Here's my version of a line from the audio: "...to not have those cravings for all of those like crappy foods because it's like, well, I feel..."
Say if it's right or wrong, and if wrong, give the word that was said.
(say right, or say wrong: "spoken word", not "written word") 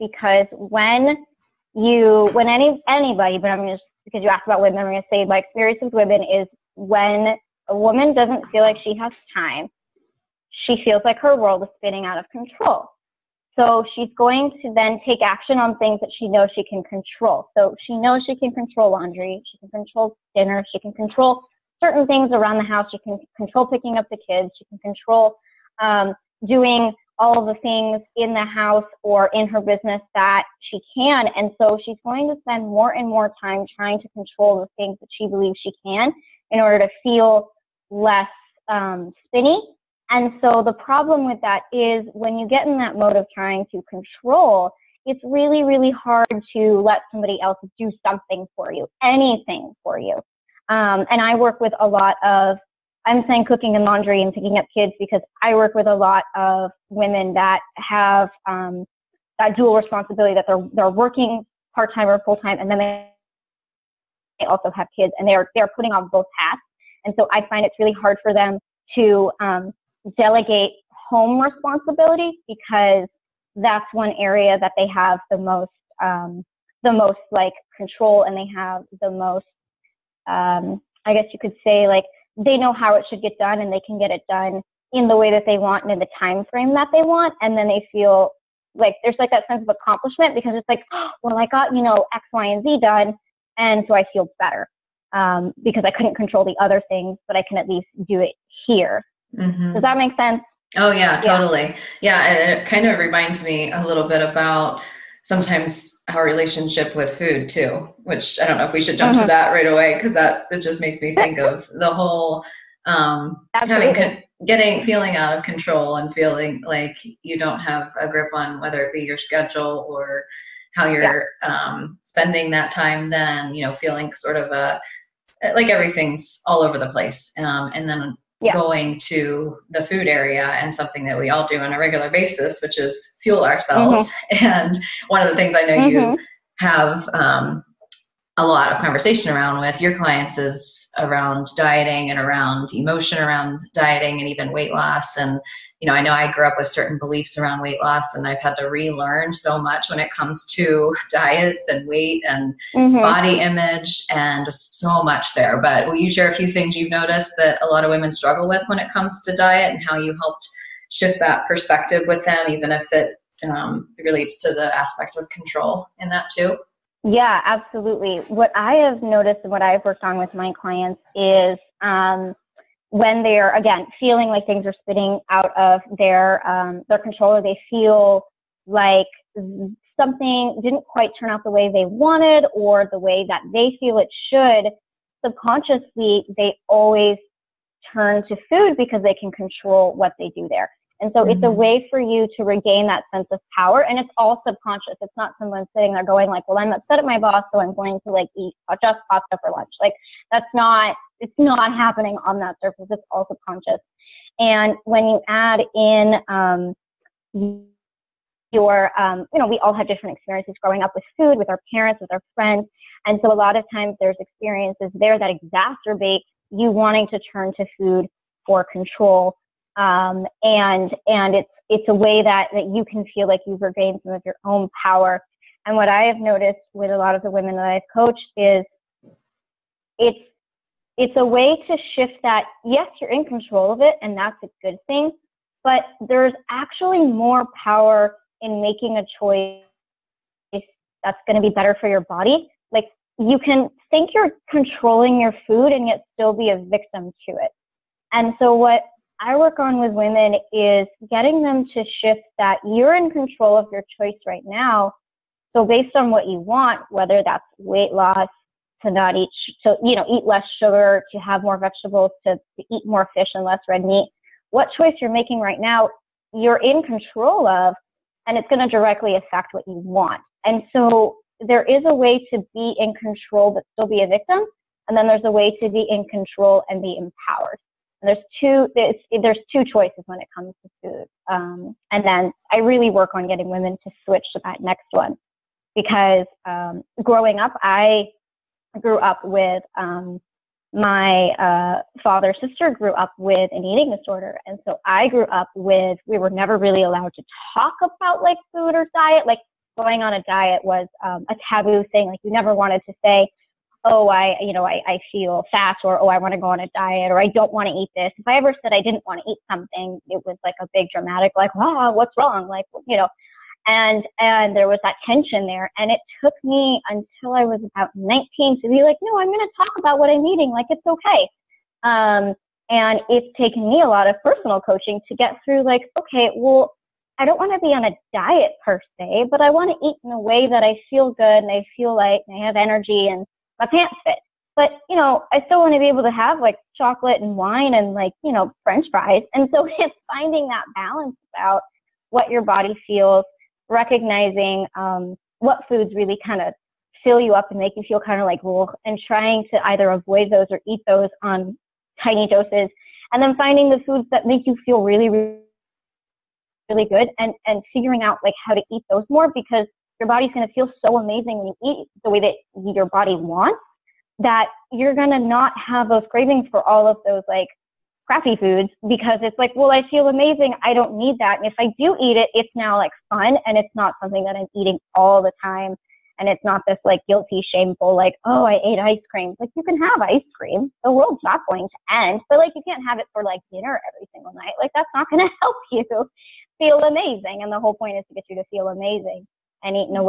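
right.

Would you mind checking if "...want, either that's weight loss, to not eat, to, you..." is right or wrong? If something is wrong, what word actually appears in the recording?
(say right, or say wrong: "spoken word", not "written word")
wrong: "whether", not "either".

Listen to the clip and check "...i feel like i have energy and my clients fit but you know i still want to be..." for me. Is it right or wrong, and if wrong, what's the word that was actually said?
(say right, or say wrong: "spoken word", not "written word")
wrong: "pants", not "clients".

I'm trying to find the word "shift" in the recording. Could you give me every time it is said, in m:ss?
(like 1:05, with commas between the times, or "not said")
2:40, 3:51, 4:12.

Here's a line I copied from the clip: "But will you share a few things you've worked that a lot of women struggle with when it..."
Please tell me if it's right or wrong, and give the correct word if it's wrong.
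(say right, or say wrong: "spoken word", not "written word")
wrong: "noticed", not "worked".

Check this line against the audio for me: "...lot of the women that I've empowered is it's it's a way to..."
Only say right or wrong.
wrong.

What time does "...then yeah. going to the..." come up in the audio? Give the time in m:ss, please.
2:07.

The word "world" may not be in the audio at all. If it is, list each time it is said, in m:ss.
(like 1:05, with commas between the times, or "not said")
0:11, 6:20.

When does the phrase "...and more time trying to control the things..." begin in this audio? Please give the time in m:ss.
0:32.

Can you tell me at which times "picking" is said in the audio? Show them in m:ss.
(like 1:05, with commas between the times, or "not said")
0:23, 0:54.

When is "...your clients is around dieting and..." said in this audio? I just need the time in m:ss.
2:19.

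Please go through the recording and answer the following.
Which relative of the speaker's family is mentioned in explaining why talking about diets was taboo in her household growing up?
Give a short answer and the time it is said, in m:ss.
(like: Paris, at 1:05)
father's sister, at 4:52.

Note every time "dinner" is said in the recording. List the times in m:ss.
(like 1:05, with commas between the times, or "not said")
0:20, 6:23.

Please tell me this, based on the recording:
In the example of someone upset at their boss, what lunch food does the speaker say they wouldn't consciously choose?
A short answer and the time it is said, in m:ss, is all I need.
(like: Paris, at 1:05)
pasta, at 3:19.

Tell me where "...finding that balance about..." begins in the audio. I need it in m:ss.
5:40.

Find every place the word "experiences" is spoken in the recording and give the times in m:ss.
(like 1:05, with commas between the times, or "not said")
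0:05, 3:30, 3:34.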